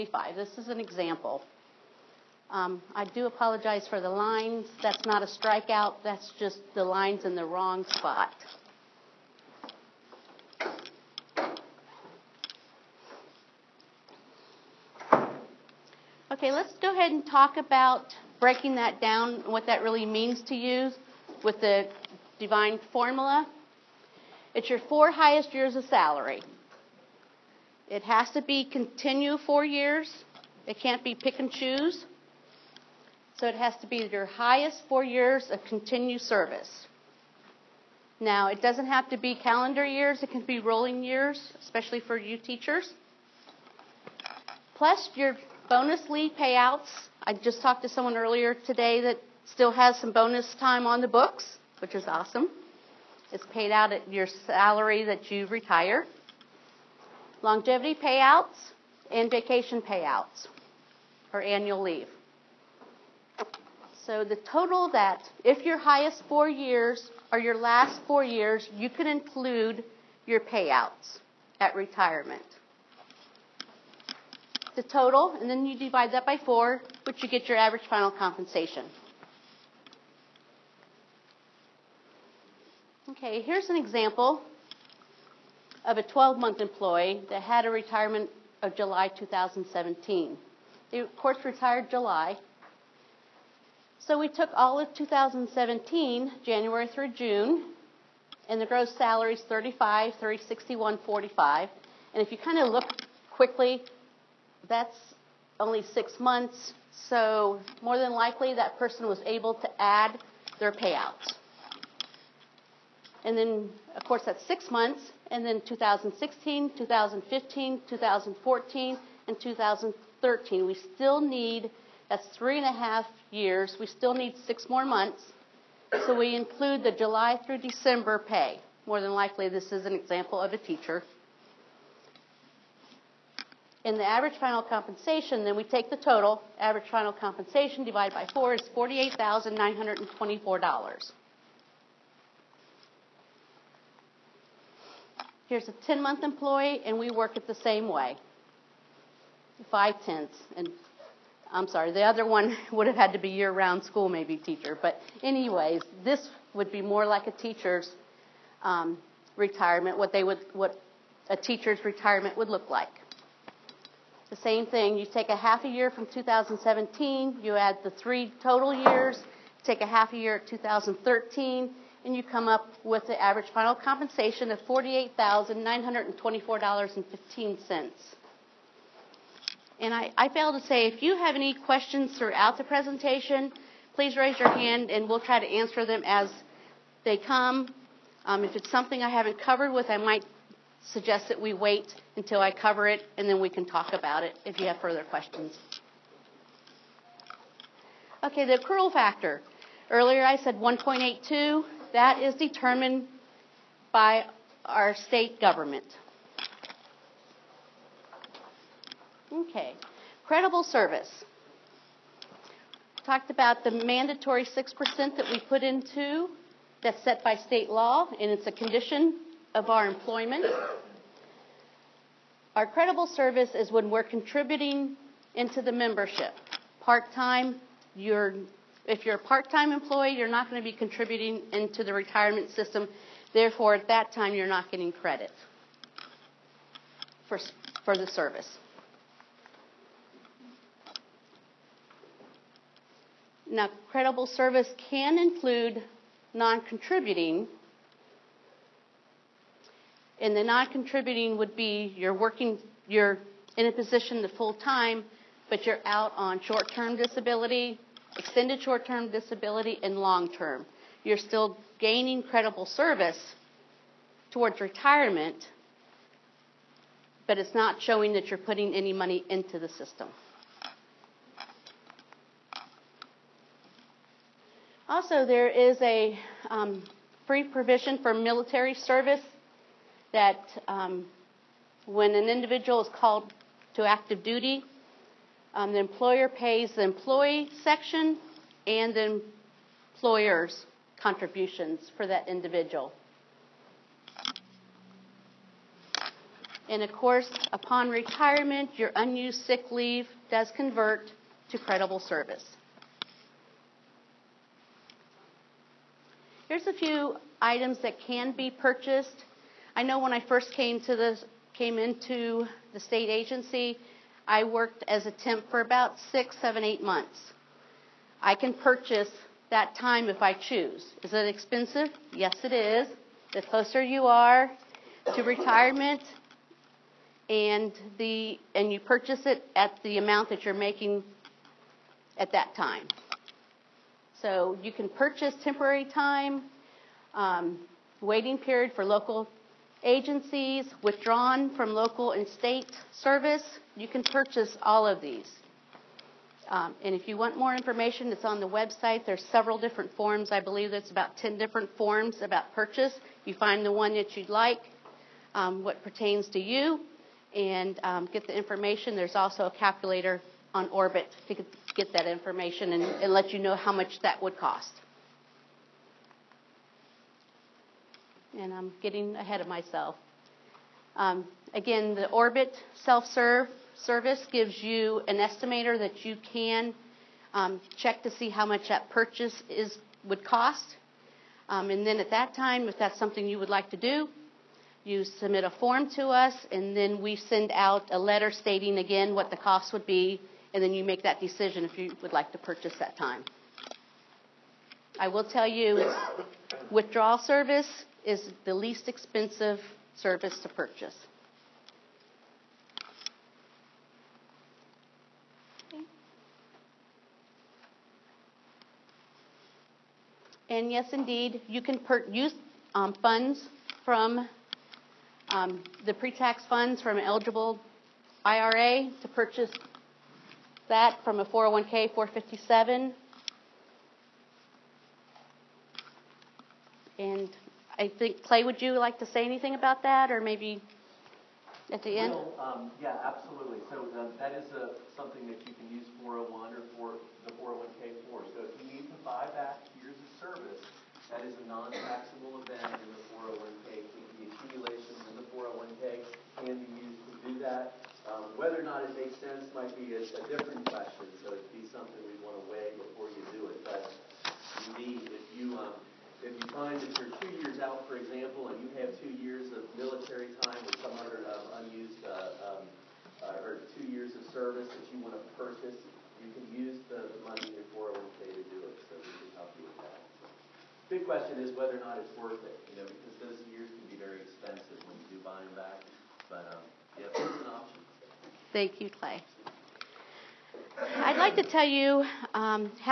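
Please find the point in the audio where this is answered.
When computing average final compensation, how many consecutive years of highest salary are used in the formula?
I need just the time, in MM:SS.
00:24.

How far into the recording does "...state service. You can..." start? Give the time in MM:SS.
05:42.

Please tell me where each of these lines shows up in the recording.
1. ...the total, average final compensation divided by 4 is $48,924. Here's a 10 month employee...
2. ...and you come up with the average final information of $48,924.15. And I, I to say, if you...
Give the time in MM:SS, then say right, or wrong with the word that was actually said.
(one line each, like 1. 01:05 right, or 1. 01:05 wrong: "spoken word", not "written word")
1. 02:15 right
2. 02:52 wrong: "compensation", not "information".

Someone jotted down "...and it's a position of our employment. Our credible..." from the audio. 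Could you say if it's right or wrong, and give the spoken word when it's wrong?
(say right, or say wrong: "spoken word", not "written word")
wrong: "condition", not "position".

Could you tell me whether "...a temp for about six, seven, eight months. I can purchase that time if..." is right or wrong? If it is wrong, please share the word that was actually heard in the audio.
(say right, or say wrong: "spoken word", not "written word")
right.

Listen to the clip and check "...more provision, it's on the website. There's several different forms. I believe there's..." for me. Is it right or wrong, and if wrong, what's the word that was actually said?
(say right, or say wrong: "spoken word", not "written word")
wrong: "information", not "provision".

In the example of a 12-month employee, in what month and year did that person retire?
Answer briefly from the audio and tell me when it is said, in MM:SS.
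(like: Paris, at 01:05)
July 2017, at 01:28.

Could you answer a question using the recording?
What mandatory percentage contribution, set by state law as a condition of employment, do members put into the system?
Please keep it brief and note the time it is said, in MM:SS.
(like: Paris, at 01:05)
6%, at 03:34.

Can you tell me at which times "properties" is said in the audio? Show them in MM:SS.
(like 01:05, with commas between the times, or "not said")
not said.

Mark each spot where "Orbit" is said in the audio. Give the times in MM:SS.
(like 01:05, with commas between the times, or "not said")
06:00, 06:12.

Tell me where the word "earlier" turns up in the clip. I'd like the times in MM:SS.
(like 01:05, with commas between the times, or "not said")
00:48, 03:19.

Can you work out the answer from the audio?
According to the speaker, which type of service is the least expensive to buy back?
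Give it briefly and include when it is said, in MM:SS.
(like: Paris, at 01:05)
Withdrawal service, at 06:36.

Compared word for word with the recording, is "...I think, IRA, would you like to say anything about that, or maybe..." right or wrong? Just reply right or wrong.
wrong.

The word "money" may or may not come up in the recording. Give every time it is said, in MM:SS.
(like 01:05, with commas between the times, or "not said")
04:28, 07:47.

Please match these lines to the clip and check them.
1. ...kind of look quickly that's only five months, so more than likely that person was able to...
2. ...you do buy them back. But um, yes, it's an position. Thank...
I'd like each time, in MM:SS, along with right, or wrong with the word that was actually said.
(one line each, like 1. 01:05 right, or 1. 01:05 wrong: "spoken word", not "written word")
1. 01:42 wrong: "six", not "five"
2. 07:55 wrong: "option", not "position".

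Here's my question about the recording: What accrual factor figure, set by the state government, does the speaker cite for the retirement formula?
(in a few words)
1.82.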